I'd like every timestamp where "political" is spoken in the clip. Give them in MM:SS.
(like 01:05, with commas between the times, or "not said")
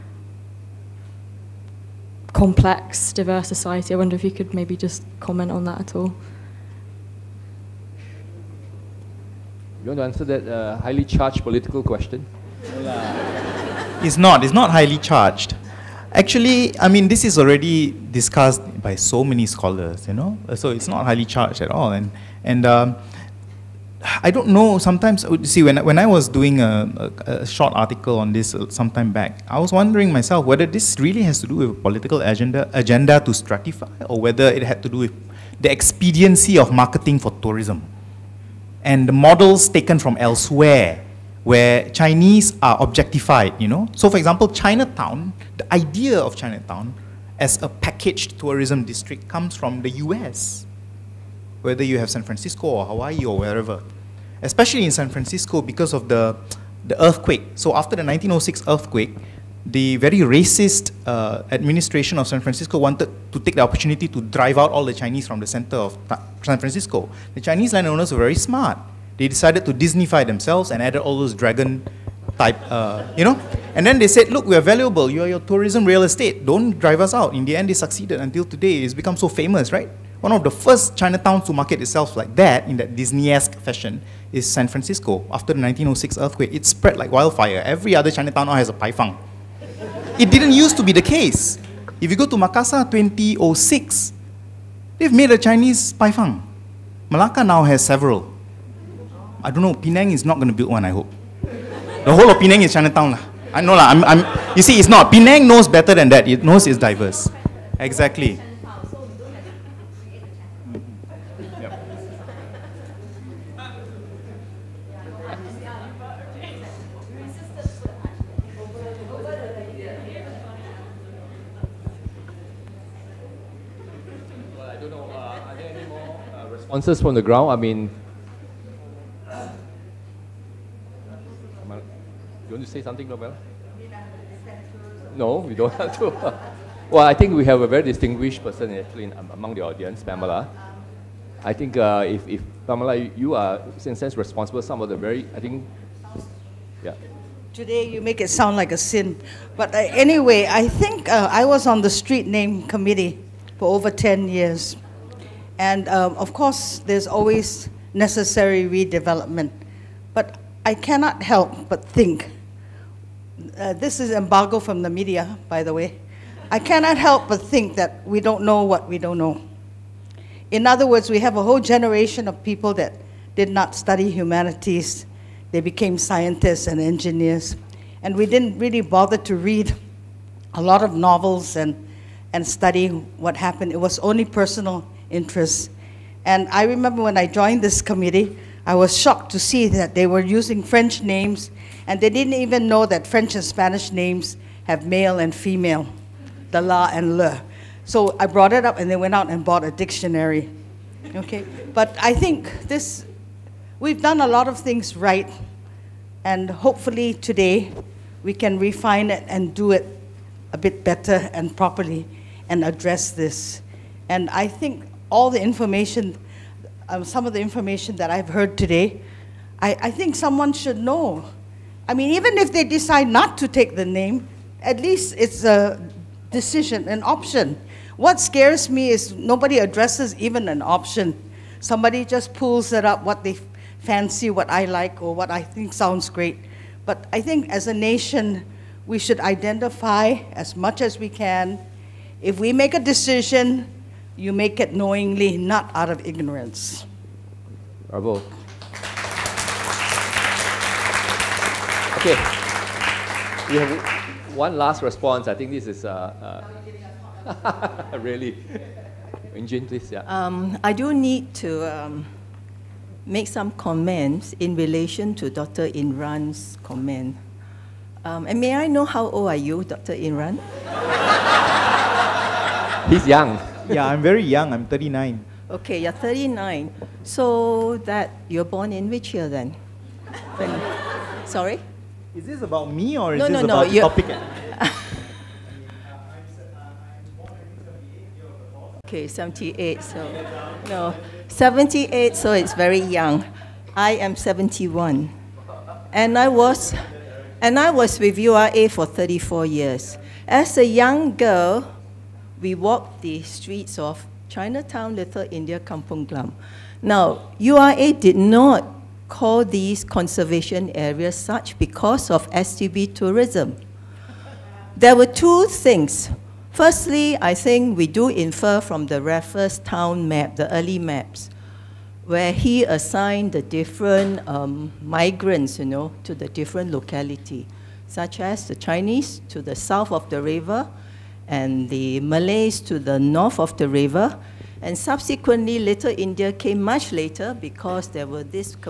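00:11, 00:31.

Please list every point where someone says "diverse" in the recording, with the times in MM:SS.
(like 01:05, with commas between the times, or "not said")
00:03, 01:46.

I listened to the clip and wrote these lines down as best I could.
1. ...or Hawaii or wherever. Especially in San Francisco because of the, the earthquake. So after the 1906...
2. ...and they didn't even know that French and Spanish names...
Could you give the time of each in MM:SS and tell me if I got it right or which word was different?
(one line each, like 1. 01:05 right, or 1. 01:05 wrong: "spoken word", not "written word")
1. 00:52 right
2. 03:11 right.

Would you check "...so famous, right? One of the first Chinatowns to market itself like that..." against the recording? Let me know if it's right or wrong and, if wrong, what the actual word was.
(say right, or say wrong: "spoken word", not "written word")
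right.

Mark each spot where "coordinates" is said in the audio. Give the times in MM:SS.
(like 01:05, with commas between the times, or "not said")
not said.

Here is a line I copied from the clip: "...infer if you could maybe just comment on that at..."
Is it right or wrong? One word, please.
wrong.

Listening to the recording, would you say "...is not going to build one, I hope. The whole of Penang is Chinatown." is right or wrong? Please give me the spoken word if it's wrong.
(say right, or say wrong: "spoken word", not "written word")
right.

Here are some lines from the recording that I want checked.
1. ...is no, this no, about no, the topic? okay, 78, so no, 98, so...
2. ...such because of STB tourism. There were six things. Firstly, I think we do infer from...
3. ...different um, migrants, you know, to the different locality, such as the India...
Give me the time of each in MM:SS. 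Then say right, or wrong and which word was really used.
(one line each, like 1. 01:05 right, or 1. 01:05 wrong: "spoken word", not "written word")
1. 04:43 wrong: "78", not "98"
2. 05:11 wrong: "two", not "six"
3. 05:23 wrong: "Chinese", not "India".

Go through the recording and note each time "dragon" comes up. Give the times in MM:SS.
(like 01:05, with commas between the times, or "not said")
01:11.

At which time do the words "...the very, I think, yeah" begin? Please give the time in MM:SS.
02:24.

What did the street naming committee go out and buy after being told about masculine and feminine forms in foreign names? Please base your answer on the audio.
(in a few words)
A dictionary.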